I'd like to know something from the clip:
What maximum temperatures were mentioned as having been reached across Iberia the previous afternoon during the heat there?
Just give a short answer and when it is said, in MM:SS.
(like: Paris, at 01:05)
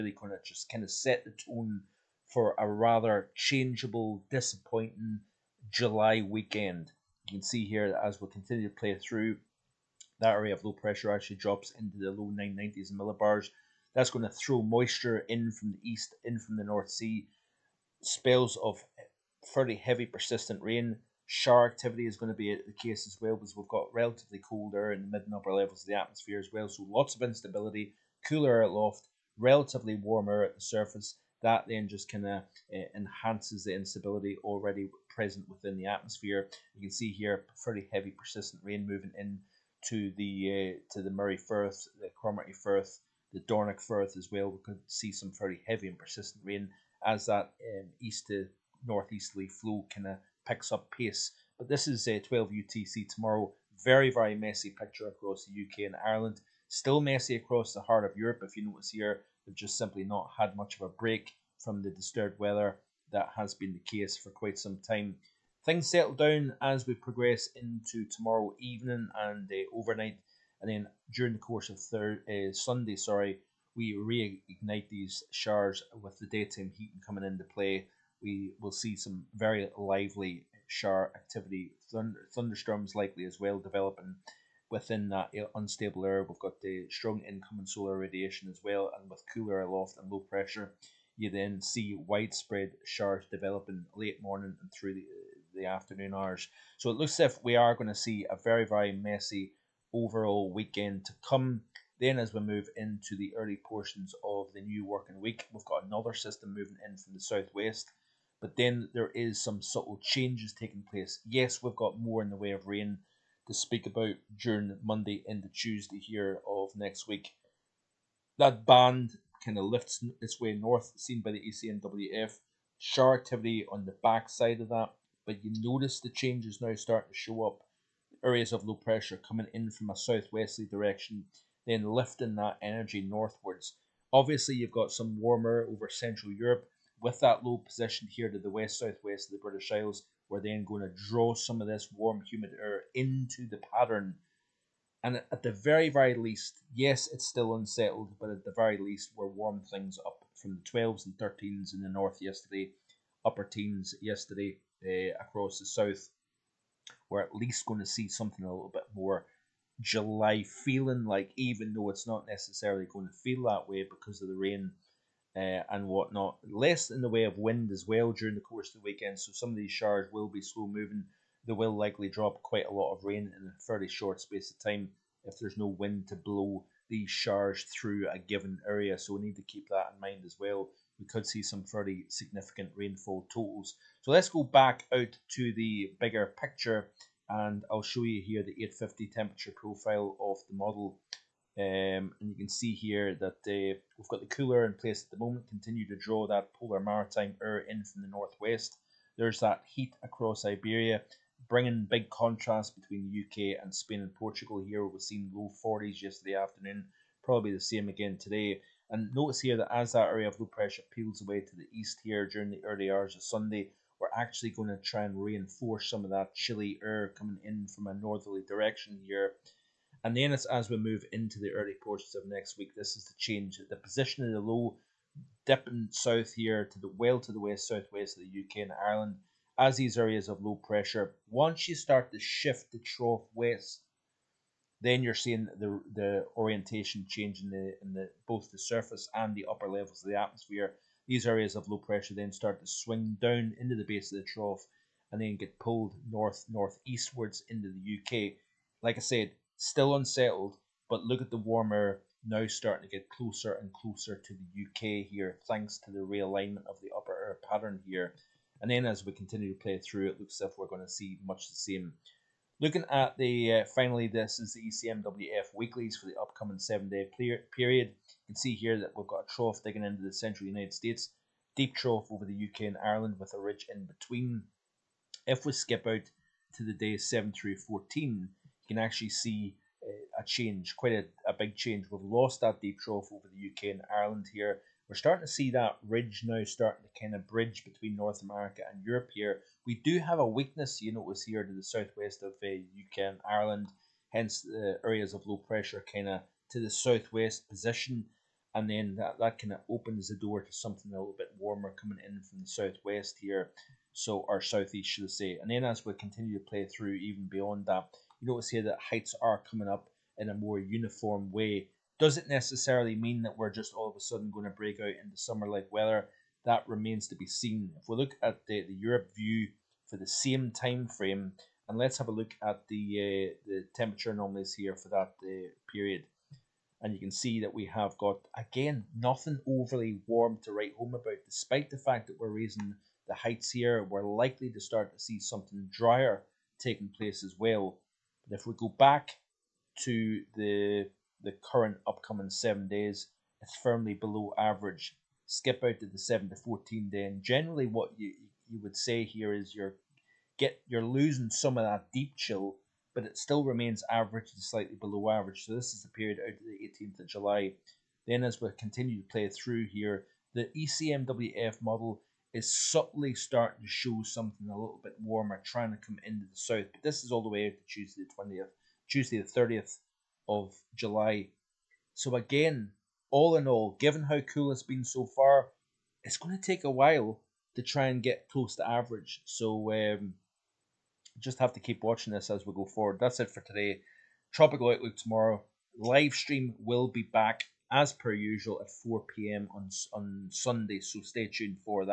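low 40s, at 03:25.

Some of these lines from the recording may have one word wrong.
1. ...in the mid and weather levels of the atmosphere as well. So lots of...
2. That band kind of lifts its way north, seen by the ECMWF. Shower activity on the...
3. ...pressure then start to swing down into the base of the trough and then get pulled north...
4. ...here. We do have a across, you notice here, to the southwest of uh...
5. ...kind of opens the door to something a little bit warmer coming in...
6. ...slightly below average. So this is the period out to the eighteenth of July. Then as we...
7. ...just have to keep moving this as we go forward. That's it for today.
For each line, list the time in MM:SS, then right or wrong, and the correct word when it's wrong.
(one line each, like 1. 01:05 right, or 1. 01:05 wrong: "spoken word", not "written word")
1. 00:24 wrong: "upper", not "weather"
2. 01:58 right
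3. 04:01 right
4. 04:49 wrong: "weakness", not "across"
5. 04:59 right
6. 05:54 right
7. 06:21 wrong: "watching", not "moving".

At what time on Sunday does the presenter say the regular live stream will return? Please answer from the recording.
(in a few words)
4 p.m.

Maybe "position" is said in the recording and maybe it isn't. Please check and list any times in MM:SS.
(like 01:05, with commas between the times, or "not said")
02:17, 03:43, 04:57.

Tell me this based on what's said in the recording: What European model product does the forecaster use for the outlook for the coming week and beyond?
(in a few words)
ECMWF weeklies.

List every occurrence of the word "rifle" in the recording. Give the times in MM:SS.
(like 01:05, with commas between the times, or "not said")
not said.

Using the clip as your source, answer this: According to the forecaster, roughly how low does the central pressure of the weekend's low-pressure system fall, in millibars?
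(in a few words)
low 990s.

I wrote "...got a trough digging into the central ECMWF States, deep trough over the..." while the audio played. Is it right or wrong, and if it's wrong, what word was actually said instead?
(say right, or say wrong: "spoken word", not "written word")
wrong: "United", not "ECMWF".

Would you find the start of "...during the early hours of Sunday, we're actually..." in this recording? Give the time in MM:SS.
03:32.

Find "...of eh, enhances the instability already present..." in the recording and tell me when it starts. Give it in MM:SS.
00:32.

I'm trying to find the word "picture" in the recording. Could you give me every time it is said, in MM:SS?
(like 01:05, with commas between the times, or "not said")
00:54, 03:06.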